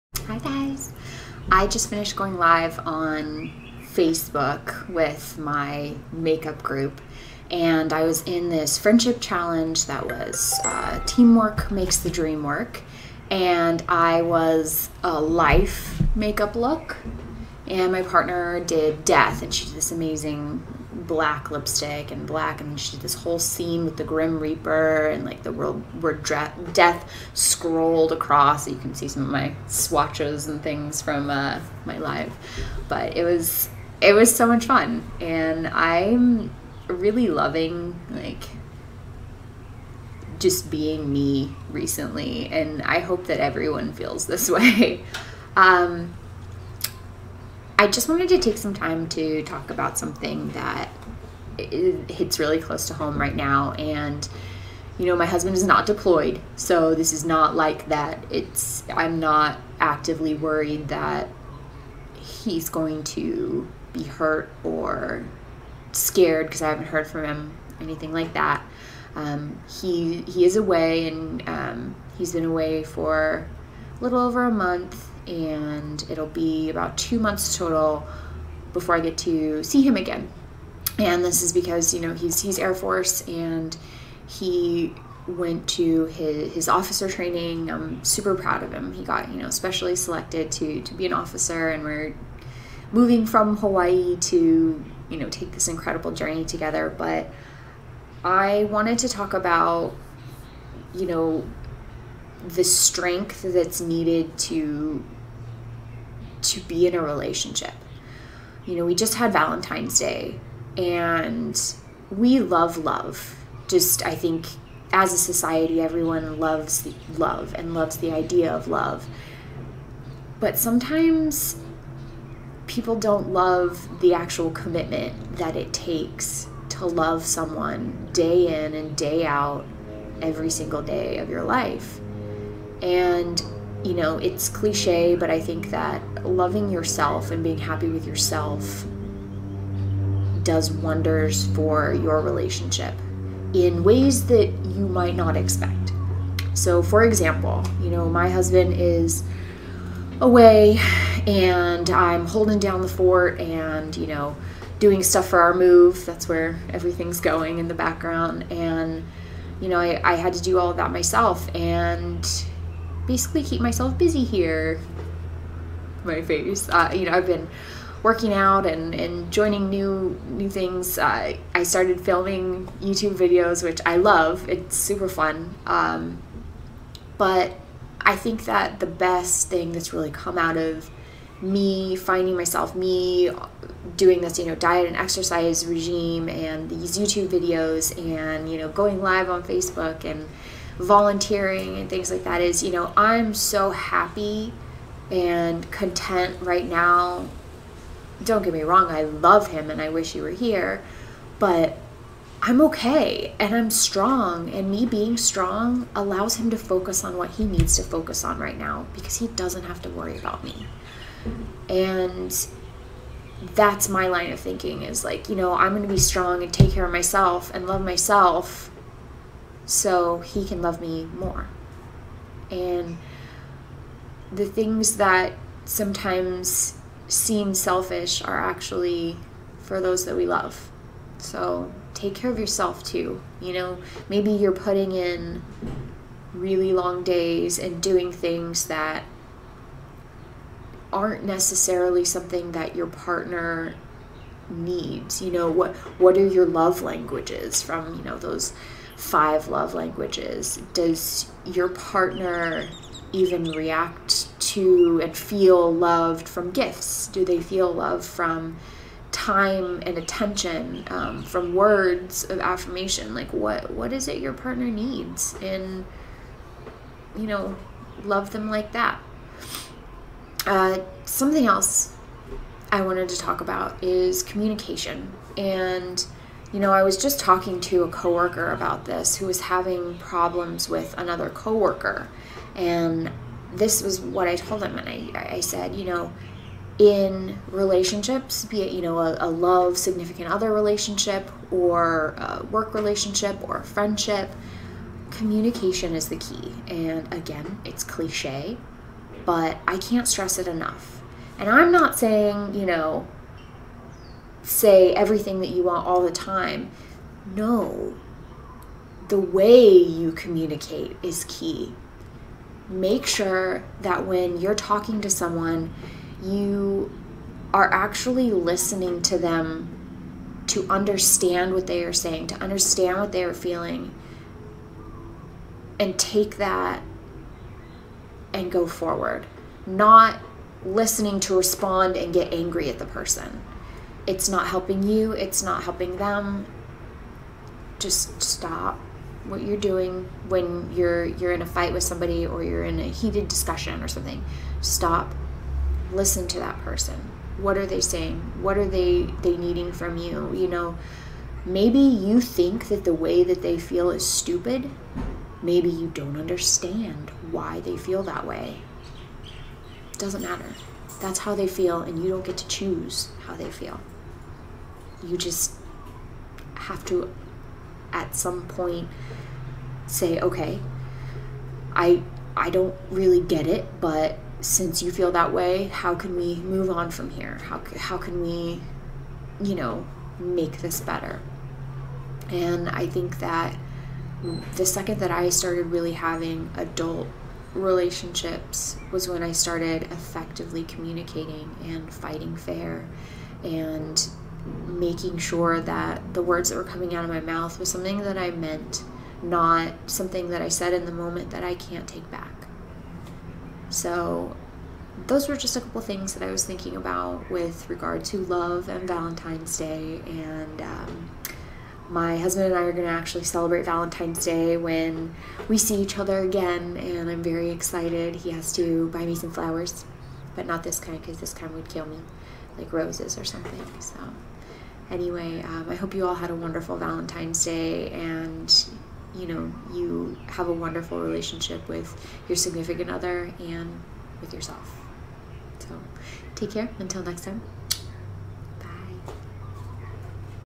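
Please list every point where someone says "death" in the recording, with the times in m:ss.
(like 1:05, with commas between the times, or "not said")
0:19, 0:26.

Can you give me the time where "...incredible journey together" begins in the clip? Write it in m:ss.
1:35.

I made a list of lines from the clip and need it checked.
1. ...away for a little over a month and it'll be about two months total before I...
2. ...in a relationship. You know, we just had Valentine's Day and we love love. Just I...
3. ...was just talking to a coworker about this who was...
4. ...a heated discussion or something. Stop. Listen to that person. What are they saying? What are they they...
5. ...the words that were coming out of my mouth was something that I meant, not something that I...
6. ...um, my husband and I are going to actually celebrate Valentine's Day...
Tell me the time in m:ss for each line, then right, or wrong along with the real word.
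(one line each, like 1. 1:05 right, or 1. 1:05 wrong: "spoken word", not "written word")
1. 1:12 right
2. 1:46 right
3. 4:36 right
4. 5:42 right
5. 6:36 right
6. 6:50 right.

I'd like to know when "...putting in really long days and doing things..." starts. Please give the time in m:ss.
3:54.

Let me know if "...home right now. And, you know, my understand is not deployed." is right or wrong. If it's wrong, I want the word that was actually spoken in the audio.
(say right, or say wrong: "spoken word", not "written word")
wrong: "husband", not "understand".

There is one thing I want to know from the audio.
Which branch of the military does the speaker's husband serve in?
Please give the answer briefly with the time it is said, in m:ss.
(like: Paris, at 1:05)
Air Force, at 1:22.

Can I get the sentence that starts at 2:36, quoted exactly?
That's where everything's going in the background.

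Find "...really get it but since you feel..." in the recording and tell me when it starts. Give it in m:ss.
6:12.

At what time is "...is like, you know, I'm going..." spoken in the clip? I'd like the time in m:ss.
3:34.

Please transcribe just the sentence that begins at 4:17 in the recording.
Do they feel love from time and attention, um, from words of affirmation?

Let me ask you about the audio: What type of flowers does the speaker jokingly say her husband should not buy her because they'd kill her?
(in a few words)
roses.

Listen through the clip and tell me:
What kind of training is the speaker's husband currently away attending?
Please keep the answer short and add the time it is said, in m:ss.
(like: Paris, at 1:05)
officer training, at 1:26.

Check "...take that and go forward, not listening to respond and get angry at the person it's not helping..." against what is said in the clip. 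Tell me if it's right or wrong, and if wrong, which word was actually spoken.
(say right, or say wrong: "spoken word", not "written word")
right.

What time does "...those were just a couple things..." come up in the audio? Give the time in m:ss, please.
6:45.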